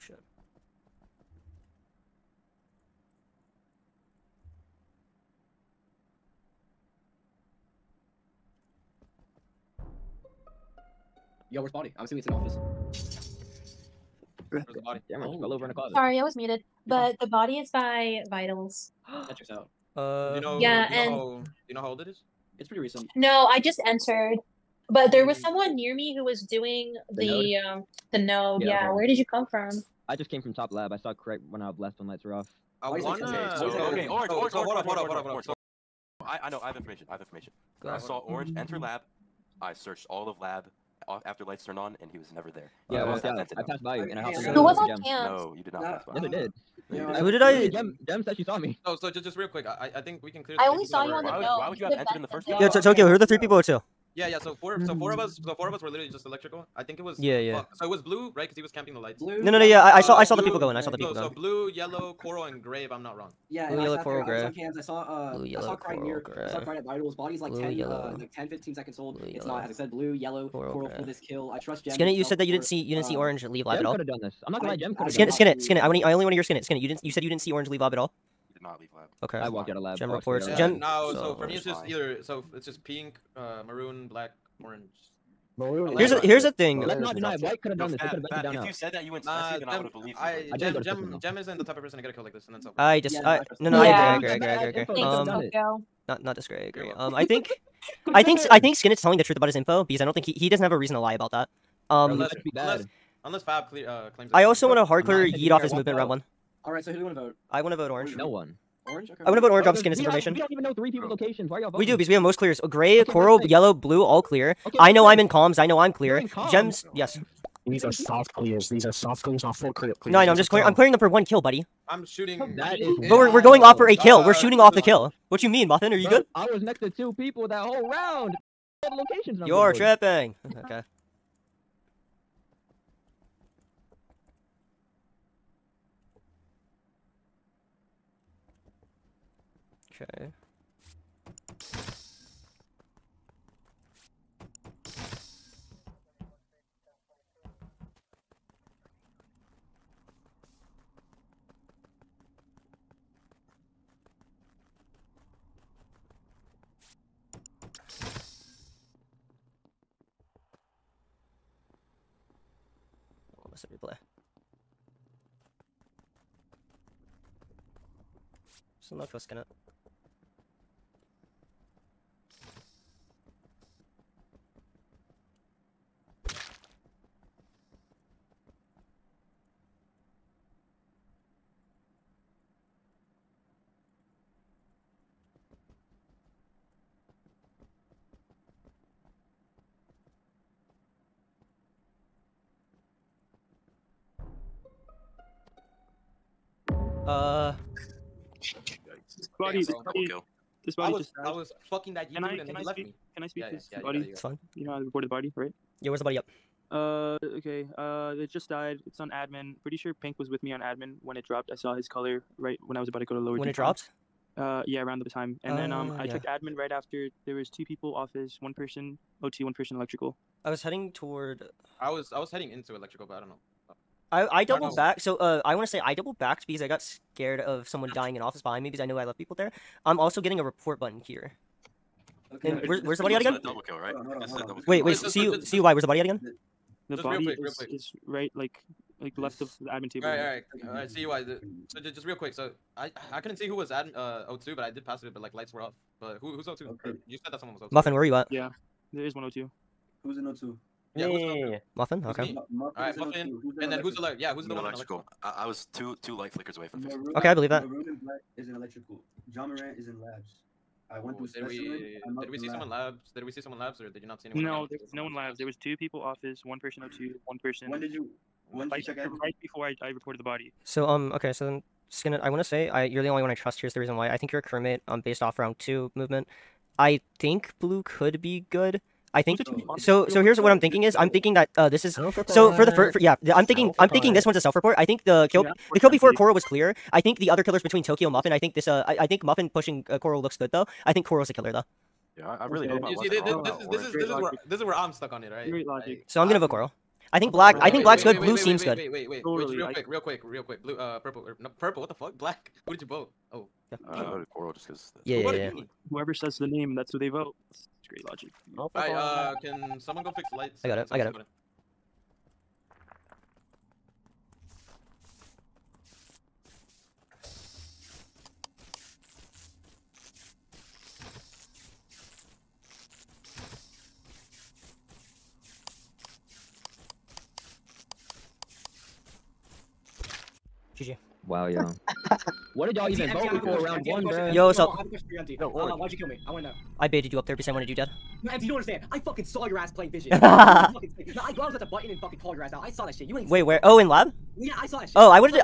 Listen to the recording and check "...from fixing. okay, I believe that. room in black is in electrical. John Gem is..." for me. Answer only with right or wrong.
wrong.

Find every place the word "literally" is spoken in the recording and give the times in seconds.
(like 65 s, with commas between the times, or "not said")
47 s, 55 s.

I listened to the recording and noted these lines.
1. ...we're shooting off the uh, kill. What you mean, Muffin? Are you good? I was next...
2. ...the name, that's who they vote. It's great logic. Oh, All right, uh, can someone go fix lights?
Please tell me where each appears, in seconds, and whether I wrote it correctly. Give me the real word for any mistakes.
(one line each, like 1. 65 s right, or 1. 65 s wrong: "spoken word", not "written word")
1. 124 s right
2. 306 s right.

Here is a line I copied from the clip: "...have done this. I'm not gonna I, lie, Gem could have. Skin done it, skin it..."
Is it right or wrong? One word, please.
right.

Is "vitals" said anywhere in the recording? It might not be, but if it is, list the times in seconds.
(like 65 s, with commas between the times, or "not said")
18 s, 66 s.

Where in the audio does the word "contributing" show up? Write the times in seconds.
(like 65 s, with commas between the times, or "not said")
not said.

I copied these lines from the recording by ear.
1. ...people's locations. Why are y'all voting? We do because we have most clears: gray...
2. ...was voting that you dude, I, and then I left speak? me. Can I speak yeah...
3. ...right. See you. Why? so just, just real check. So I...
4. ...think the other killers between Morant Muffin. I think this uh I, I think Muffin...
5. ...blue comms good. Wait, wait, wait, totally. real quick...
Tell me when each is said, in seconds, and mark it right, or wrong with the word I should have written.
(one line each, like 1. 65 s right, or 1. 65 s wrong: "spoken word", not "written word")
1. 110 s right
2. 201 s wrong: "fucking", not "voting"
3. 240 s wrong: "quick", not "check"
4. 287 s wrong: "Tokyo", not "Morant"
5. 298 s wrong: "seems", not "comms".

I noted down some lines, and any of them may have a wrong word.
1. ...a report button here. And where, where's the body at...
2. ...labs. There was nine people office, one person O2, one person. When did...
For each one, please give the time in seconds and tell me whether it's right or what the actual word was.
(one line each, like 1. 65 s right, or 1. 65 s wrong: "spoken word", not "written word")
1. 230 s right
2. 265 s wrong: "two", not "nine".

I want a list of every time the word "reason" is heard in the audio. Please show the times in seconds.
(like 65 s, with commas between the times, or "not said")
100 s, 273 s.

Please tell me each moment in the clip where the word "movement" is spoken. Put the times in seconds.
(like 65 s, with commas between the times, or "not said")
105 s, 275 s.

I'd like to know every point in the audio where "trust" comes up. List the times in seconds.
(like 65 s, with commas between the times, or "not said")
71 s, 273 s.